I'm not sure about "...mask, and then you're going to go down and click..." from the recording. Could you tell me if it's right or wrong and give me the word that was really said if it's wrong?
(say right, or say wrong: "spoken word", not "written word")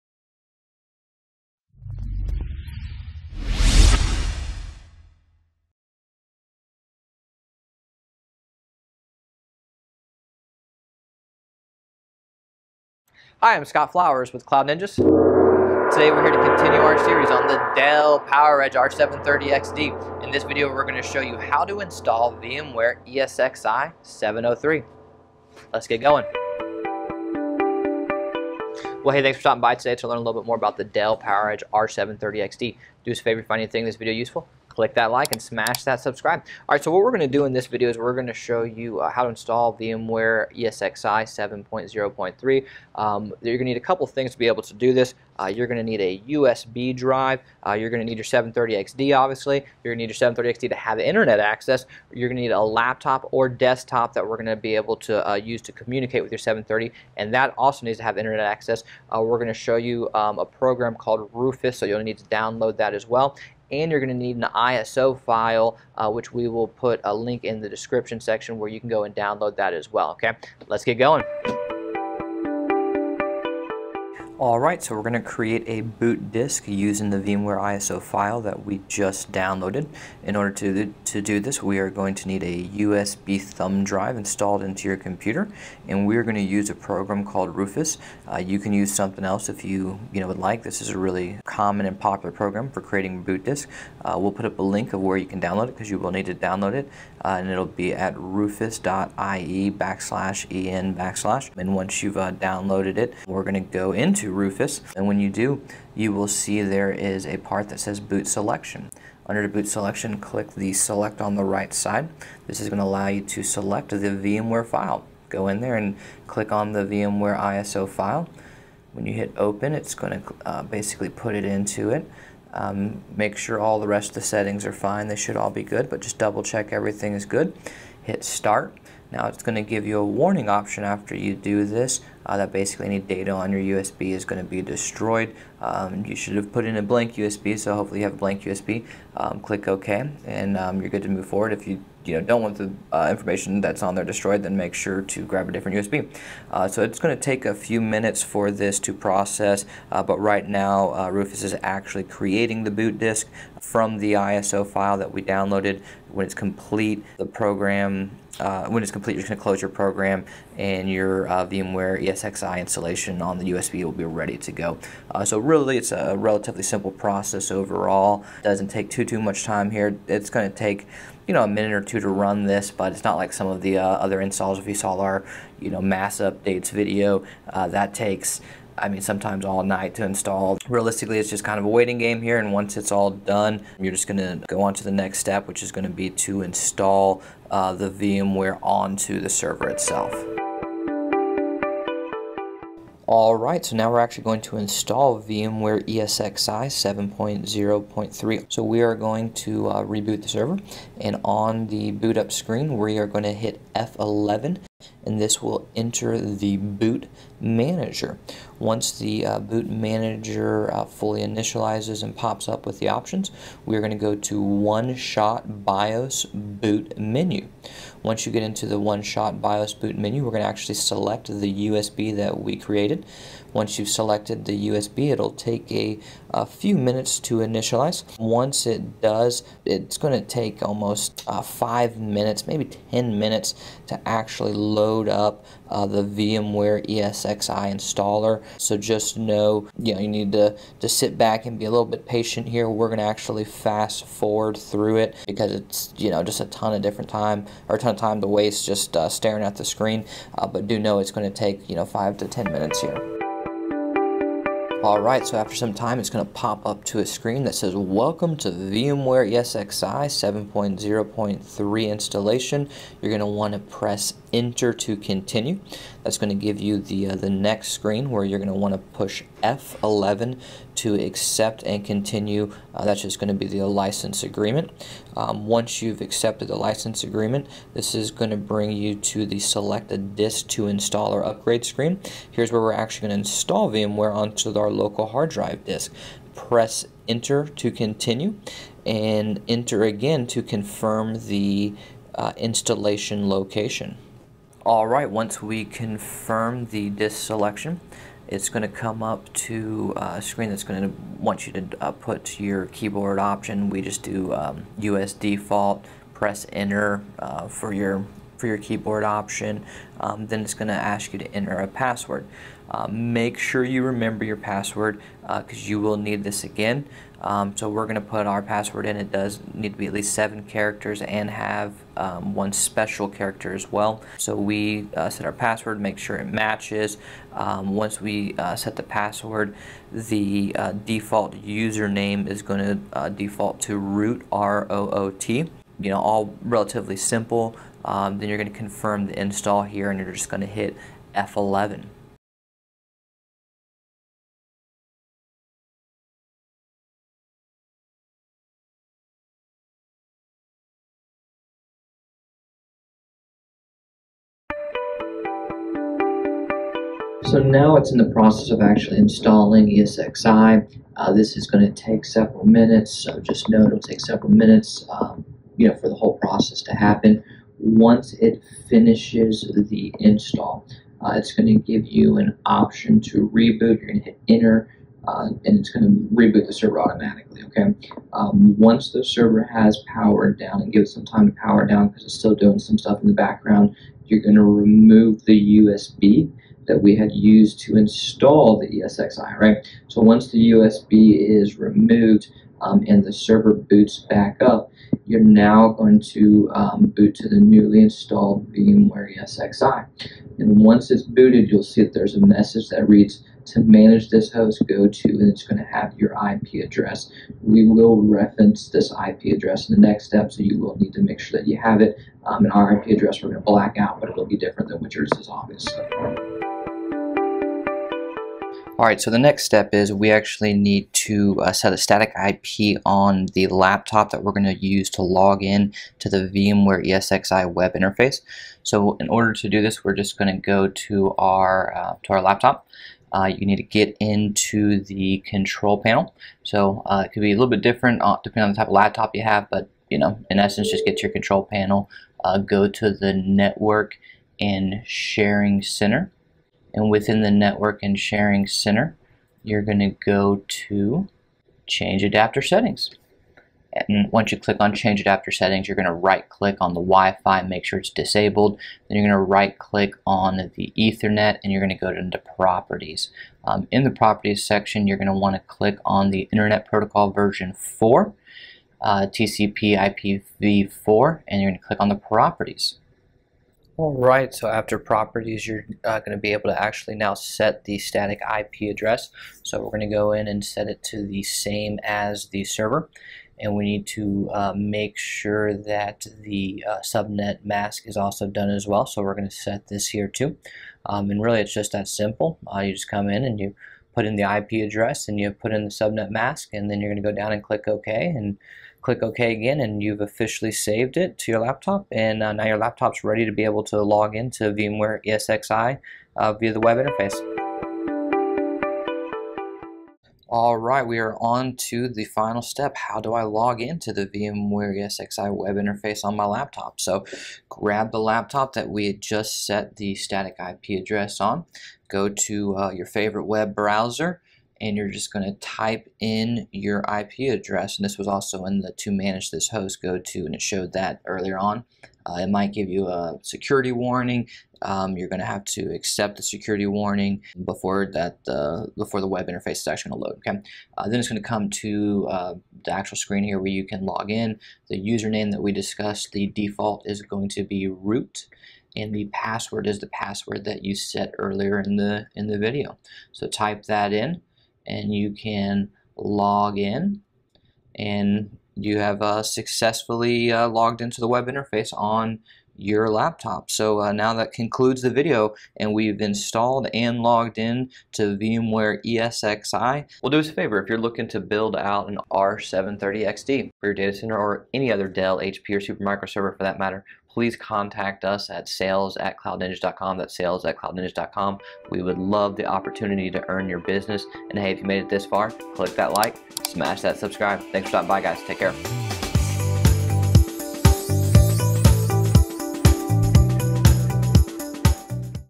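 right.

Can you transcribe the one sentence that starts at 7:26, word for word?
And within the network and sharing center, you're going to go to change adapter settings.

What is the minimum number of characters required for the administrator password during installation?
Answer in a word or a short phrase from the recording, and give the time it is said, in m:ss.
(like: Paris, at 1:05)
7, at 5:20.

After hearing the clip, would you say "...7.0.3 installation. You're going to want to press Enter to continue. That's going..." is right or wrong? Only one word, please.
right.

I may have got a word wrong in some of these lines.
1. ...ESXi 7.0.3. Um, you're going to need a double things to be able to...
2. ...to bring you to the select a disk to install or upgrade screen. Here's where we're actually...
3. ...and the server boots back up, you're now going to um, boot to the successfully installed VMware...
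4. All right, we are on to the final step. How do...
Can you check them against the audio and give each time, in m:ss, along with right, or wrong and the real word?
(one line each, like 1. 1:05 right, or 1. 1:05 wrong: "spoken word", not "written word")
1. 0:40 wrong: "couple", not "double"
2. 4:38 right
3. 6:32 wrong: "newly", not "successfully"
4. 8:30 right.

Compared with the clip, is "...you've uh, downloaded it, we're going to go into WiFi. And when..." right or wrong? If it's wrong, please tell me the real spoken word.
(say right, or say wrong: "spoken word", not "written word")
wrong: "Rufus", not "WiFi".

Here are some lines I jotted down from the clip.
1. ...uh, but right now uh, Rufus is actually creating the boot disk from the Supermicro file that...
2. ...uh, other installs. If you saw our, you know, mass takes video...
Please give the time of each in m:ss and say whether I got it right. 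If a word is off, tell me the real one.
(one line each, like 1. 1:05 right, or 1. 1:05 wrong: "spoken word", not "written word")
1. 2:29 wrong: "ISO", not "Supermicro"
2. 2:53 wrong: "updates", not "takes".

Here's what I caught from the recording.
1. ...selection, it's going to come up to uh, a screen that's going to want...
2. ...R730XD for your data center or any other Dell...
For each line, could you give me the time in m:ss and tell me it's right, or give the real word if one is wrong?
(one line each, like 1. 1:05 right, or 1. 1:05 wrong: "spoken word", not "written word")
1. 4:57 right
2. 9:32 right.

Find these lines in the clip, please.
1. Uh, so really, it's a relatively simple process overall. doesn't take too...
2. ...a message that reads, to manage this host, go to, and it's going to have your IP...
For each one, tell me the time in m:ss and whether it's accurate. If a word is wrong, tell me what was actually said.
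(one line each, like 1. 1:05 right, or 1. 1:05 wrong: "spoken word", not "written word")
1. 2:45 right
2. 6:42 right.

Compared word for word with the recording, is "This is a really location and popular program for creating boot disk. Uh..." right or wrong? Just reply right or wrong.
wrong.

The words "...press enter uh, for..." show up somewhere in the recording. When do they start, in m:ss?
5:06.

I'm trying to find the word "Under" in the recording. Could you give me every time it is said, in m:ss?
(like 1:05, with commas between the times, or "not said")
1:49.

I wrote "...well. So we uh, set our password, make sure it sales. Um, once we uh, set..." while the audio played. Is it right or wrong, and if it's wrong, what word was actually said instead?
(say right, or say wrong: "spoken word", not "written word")
wrong: "matches", not "sales".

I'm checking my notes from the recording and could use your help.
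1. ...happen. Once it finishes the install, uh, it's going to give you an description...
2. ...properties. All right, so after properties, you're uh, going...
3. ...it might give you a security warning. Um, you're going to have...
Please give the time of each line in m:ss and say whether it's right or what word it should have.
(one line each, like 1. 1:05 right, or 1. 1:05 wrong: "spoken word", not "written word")
1. 6:06 wrong: "option", not "description"
2. 7:51 right
3. 8:52 right.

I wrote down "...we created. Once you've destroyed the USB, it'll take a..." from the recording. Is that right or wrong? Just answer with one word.
wrong.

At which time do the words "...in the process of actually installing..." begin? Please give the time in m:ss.
5:57.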